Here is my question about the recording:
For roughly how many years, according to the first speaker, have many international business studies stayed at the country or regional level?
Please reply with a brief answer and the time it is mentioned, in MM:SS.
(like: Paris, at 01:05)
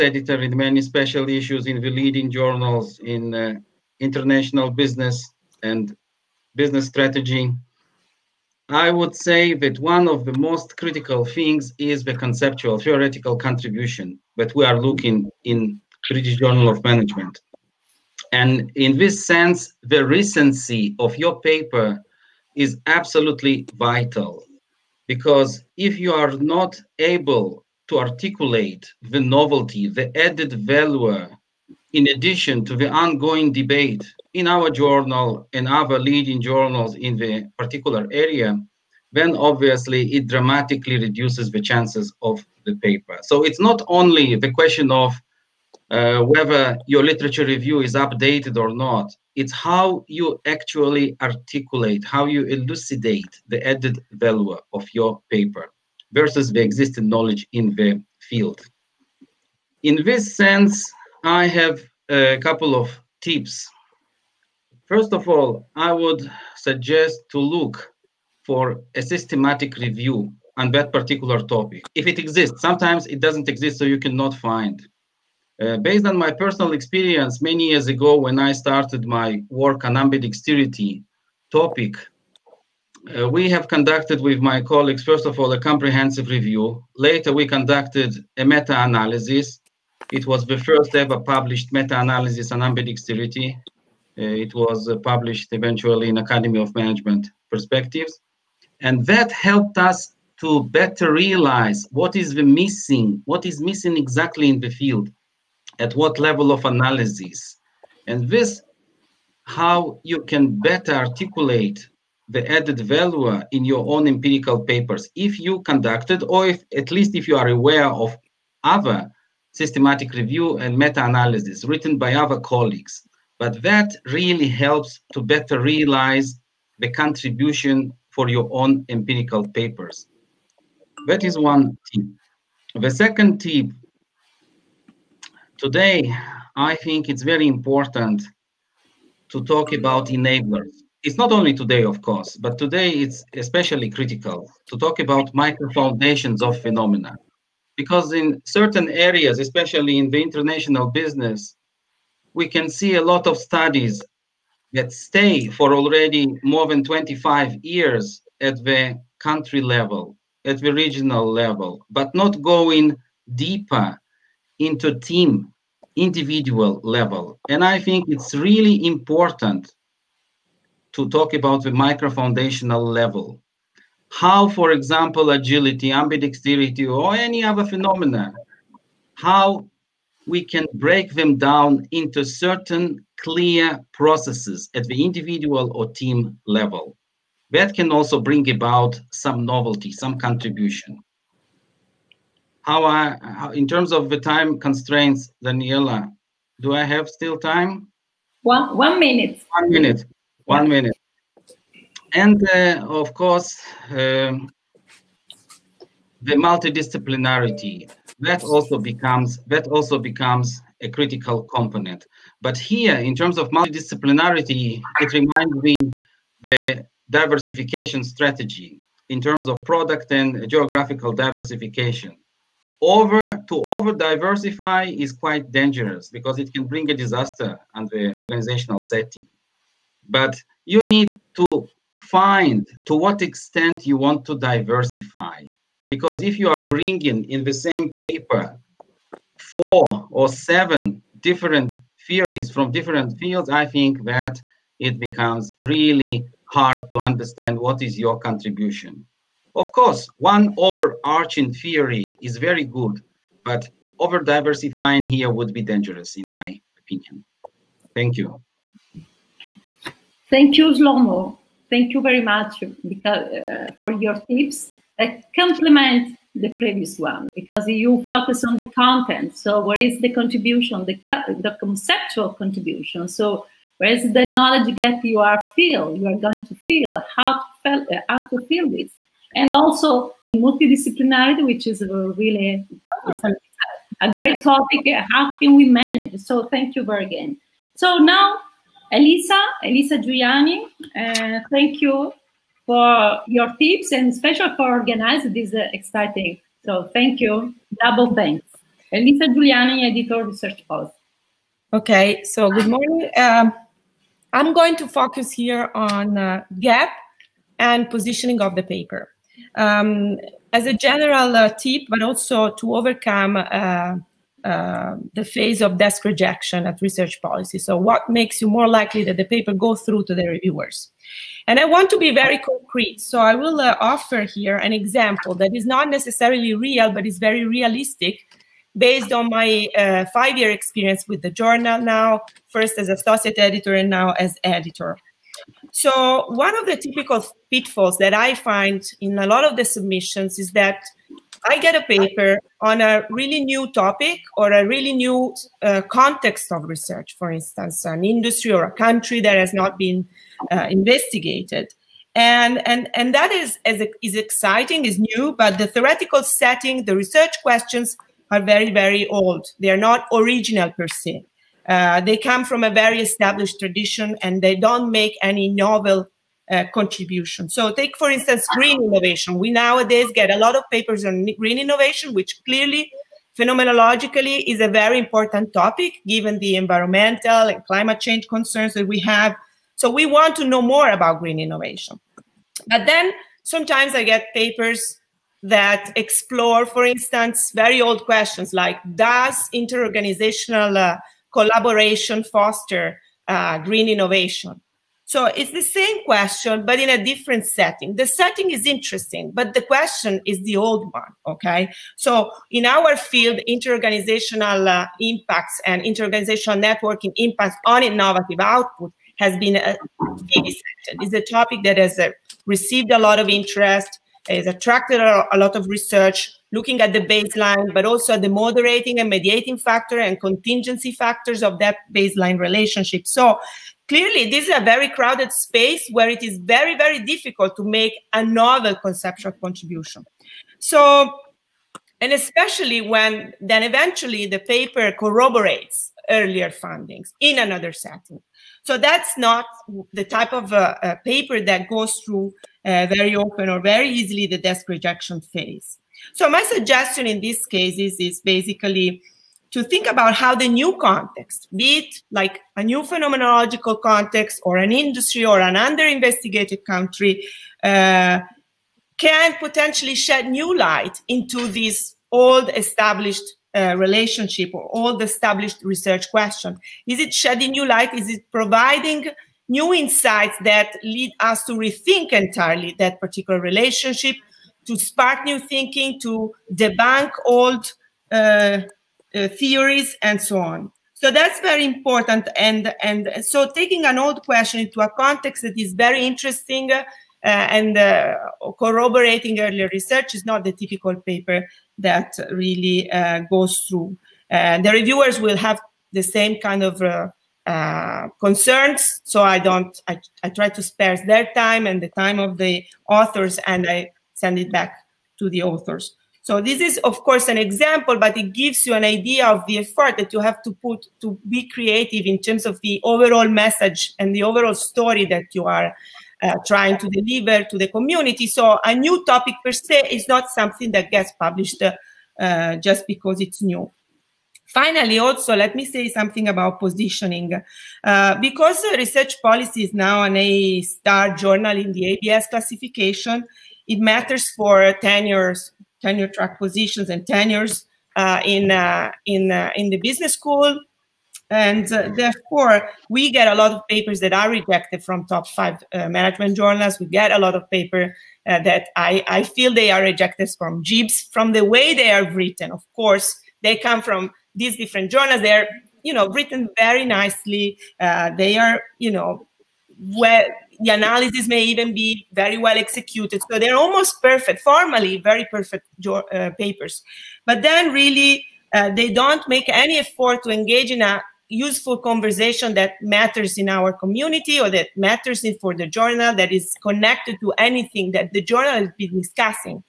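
25, at 02:36.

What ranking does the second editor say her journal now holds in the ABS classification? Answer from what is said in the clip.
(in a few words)
A-star.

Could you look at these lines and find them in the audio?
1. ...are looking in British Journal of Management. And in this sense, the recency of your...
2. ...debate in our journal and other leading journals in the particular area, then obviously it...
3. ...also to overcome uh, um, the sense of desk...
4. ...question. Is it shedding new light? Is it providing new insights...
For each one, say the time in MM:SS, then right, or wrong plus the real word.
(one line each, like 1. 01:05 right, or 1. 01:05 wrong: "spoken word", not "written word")
1. 00:14 right
2. 00:33 right
3. 05:12 wrong: "phase", not "sense"
4. 07:46 right.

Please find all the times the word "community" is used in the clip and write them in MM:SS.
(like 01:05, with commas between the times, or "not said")
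08:37, 09:33.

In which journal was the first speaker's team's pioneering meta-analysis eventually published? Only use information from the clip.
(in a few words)
Academy of Management Perspectives.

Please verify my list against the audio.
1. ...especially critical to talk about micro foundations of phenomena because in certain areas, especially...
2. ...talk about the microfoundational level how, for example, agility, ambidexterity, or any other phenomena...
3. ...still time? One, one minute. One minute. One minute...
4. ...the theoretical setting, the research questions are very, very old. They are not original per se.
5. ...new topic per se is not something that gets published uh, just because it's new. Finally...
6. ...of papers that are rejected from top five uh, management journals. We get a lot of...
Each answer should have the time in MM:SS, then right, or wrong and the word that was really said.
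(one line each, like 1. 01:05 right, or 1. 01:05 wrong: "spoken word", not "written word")
1. 02:23 right
2. 02:51 right
3. 03:17 right
4. 05:55 right
5. 08:38 right
6. 09:03 right.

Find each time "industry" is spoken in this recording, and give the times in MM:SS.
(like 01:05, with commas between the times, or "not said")
05:48, 07:34.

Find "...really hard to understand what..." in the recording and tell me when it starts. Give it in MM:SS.
04:05.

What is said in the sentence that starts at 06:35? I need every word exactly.
So it's the same question, but in a different setting.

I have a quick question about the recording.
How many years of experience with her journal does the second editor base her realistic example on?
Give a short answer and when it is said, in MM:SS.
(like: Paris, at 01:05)
5, at 05:30.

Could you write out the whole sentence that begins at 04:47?
So now Elisa, Elisa Giuliani, uh, thank you for your tips and special for organizing this uh, exciting.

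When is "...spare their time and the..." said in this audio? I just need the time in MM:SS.
08:20.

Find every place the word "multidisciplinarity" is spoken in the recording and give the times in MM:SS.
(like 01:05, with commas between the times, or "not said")
03:26, 03:33, 04:40.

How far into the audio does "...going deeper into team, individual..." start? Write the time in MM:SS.
02:42.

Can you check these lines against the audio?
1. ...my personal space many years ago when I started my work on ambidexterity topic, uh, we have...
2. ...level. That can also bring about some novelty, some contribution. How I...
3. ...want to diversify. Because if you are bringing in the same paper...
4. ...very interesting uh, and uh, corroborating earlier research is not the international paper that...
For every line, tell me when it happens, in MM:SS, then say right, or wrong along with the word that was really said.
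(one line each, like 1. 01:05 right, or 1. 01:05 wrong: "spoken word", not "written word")
1. 01:16 wrong: "experience", not "space"
2. 03:06 right
3. 03:53 right
4. 08:05 wrong: "typical", not "international".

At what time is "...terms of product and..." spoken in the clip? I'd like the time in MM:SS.
03:39.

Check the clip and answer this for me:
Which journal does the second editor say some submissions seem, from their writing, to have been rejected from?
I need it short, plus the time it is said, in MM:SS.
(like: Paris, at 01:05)
JIBS, at 09:10.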